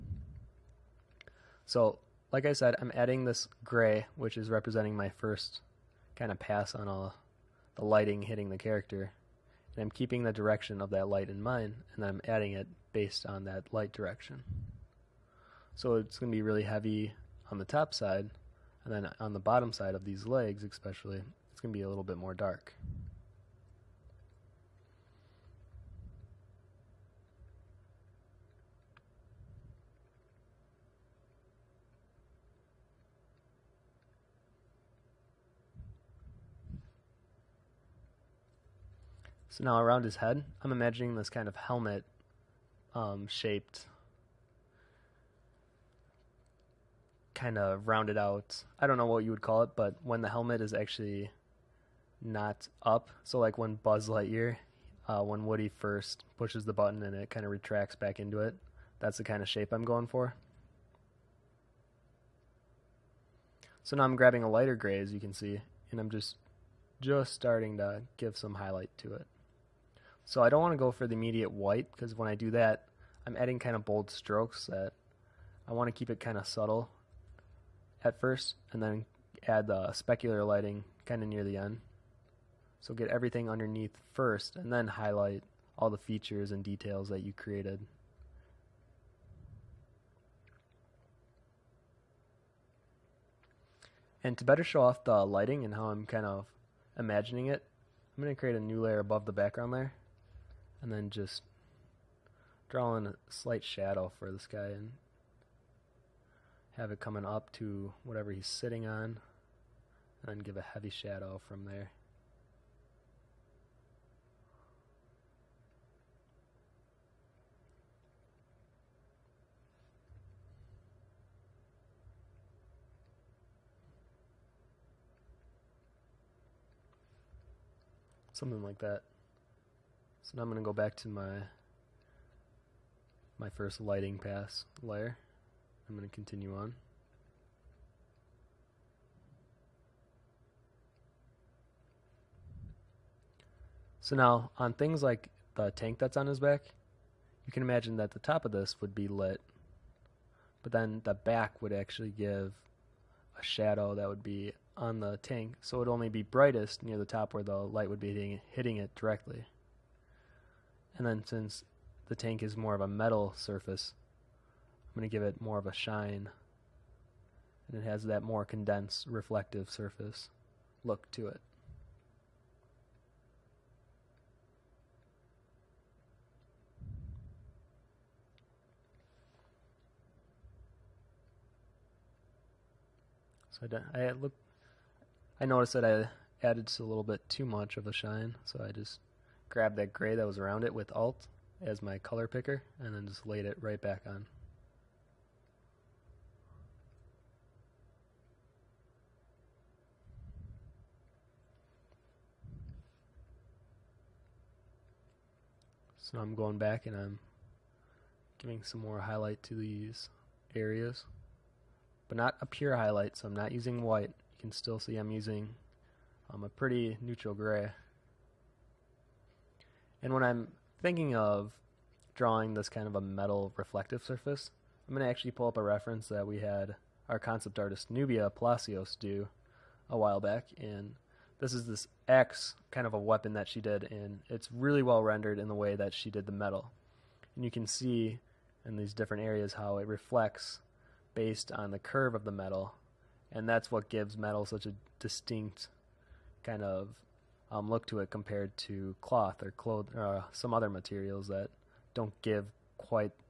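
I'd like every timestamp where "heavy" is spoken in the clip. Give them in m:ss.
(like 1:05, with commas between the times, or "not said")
0:16, 1:50.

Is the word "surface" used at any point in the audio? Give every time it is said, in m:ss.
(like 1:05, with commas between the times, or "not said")
2:43, 2:49, 3:44.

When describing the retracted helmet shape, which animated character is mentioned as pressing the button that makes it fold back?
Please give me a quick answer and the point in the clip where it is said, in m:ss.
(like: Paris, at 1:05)
Woody, at 0:55.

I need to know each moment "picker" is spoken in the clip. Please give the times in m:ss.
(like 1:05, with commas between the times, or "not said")
3:12.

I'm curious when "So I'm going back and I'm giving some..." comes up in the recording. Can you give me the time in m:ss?
3:26.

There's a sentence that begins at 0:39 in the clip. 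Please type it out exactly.
So now around his head, I'm imagining this kind of helmet um, shaped, kind of rounded out.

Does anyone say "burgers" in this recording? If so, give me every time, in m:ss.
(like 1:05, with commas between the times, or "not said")
not said.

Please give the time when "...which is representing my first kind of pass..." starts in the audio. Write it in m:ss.
0:04.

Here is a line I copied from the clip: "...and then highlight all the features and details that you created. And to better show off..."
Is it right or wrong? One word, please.
right.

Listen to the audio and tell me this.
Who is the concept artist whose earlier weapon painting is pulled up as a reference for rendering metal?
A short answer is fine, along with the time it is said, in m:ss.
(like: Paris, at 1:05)
Nubia Palacios, at 3:47.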